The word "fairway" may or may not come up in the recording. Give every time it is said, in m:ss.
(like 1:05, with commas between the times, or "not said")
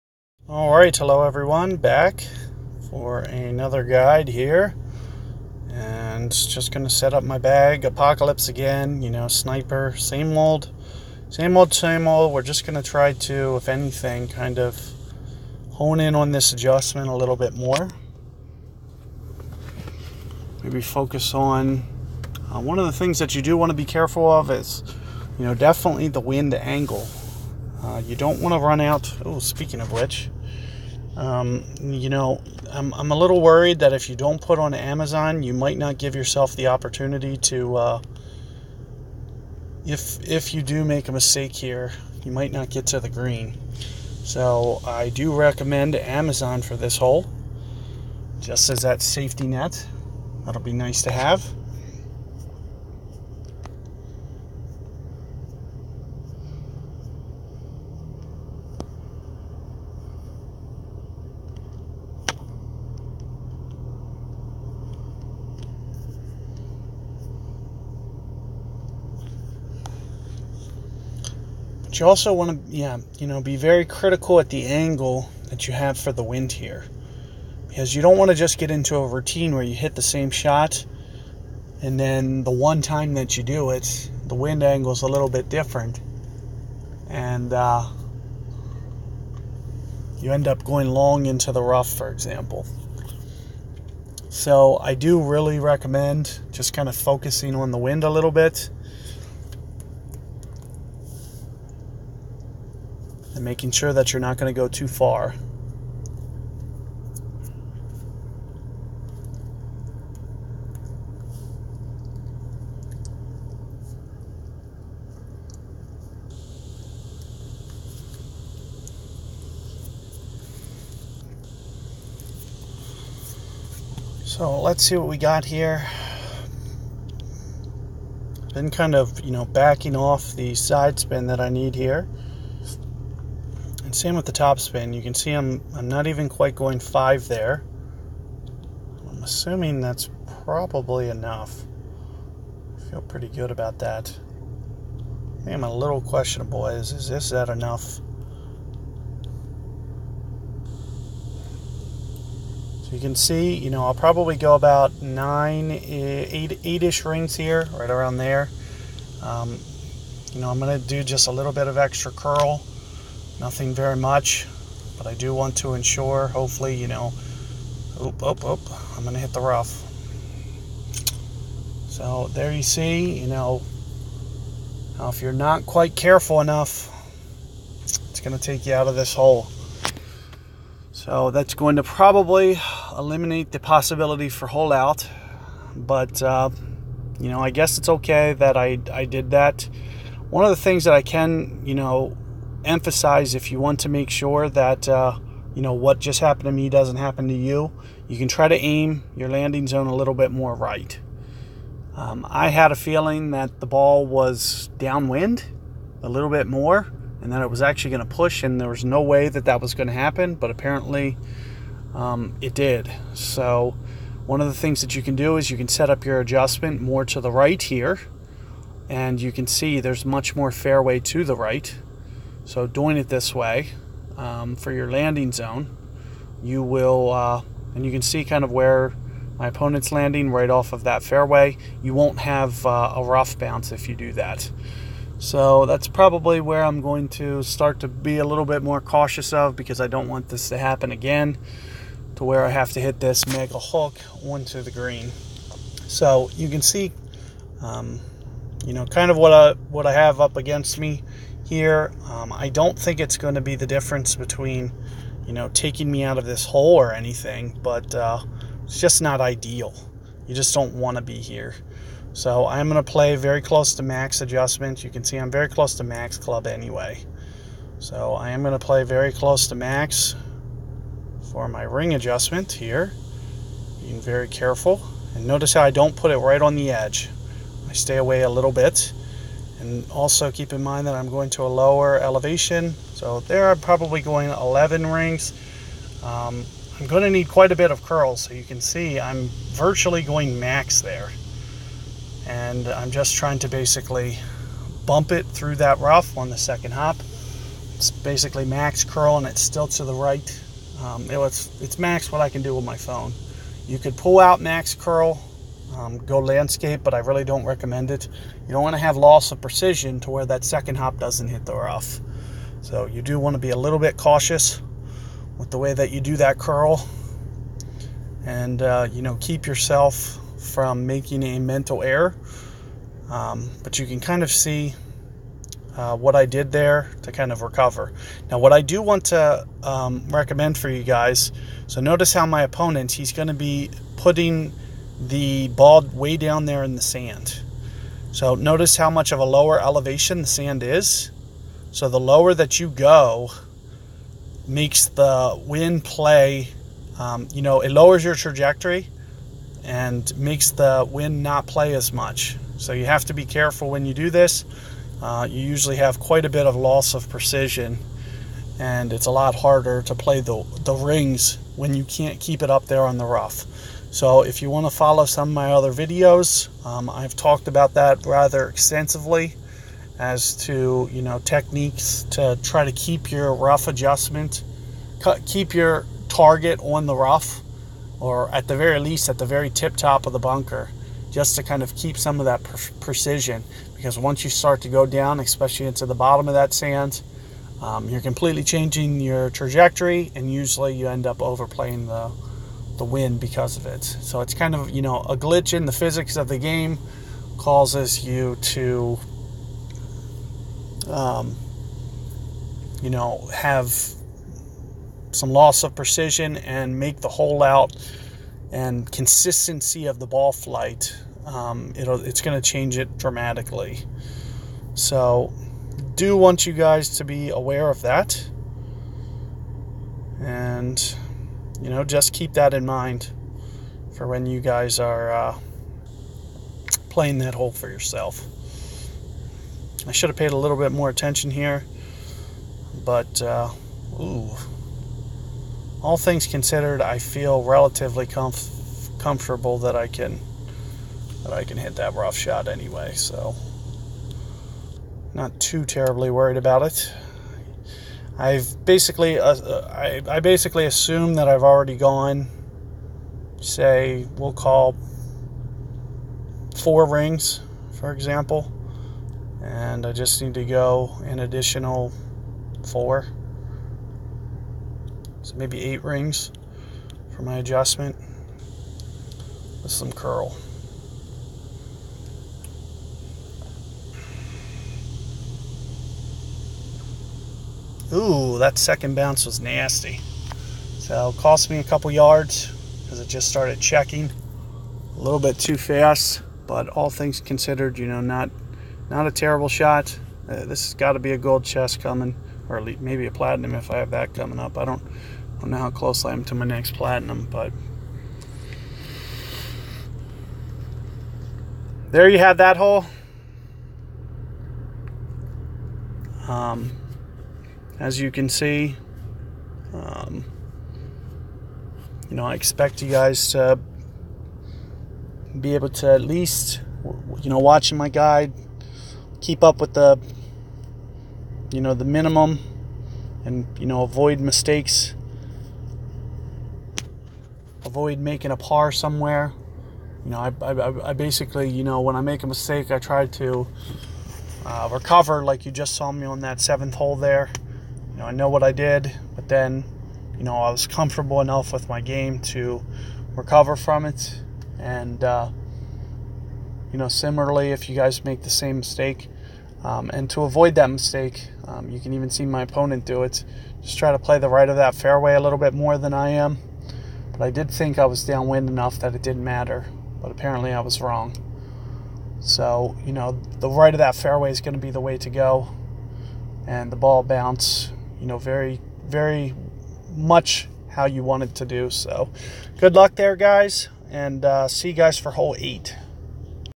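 3:40, 3:51, 9:14, 9:23.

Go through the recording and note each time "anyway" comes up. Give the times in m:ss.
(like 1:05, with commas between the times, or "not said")
4:26, 7:22.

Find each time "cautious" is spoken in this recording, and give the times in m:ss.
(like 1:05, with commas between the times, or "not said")
3:58, 5:13.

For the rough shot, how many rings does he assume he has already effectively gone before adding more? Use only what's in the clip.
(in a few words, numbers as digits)
4.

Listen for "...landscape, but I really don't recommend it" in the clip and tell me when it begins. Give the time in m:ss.
5:06.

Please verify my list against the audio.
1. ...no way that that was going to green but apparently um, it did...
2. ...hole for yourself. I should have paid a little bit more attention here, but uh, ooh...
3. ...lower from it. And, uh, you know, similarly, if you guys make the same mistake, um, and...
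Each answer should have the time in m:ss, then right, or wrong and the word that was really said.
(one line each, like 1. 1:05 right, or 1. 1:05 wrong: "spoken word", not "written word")
1. 3:28 wrong: "happen", not "green"
2. 7:07 right
3. 9:03 wrong: "recover", not "lower".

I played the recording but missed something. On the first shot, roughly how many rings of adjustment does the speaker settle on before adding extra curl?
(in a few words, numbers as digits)
8.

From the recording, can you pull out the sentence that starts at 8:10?
Uh, this has got to be a gold chest coming, or maybe a platinum if I have that coming up.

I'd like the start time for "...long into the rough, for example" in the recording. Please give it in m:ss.
1:30.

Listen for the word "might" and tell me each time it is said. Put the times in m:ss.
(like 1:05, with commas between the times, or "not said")
0:35, 0:42.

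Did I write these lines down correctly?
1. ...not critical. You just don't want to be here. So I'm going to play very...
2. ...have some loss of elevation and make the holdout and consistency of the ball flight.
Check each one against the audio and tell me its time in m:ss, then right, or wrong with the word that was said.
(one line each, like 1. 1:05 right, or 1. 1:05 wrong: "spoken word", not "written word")
1. 4:19 wrong: "ideal", not "critical"
2. 6:43 wrong: "precision", not "elevation".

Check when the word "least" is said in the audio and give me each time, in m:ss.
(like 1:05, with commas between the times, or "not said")
6:18, 8:36.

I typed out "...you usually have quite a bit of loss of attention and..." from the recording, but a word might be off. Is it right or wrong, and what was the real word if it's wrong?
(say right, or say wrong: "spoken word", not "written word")
wrong: "precision", not "attention".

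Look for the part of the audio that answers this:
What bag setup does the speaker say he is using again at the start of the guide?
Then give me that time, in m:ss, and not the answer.
0:07.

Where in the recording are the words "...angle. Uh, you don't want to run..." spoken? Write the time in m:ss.
0:26.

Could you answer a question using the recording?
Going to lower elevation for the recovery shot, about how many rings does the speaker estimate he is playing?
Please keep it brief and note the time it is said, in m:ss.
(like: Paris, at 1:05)
11, at 4:44.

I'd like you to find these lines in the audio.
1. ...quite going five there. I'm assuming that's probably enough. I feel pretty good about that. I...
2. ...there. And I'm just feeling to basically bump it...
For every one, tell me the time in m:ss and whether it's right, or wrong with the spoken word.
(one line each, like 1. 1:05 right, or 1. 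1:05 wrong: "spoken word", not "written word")
1. 2:16 right
2. 4:50 wrong: "trying", not "feeling".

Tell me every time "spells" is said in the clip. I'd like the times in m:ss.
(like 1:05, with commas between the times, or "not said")
not said.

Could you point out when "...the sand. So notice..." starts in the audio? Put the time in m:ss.
5:36.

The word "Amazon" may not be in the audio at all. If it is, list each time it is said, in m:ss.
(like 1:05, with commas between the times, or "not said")
0:34, 0:45.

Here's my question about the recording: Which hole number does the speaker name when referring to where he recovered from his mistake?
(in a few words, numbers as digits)
7.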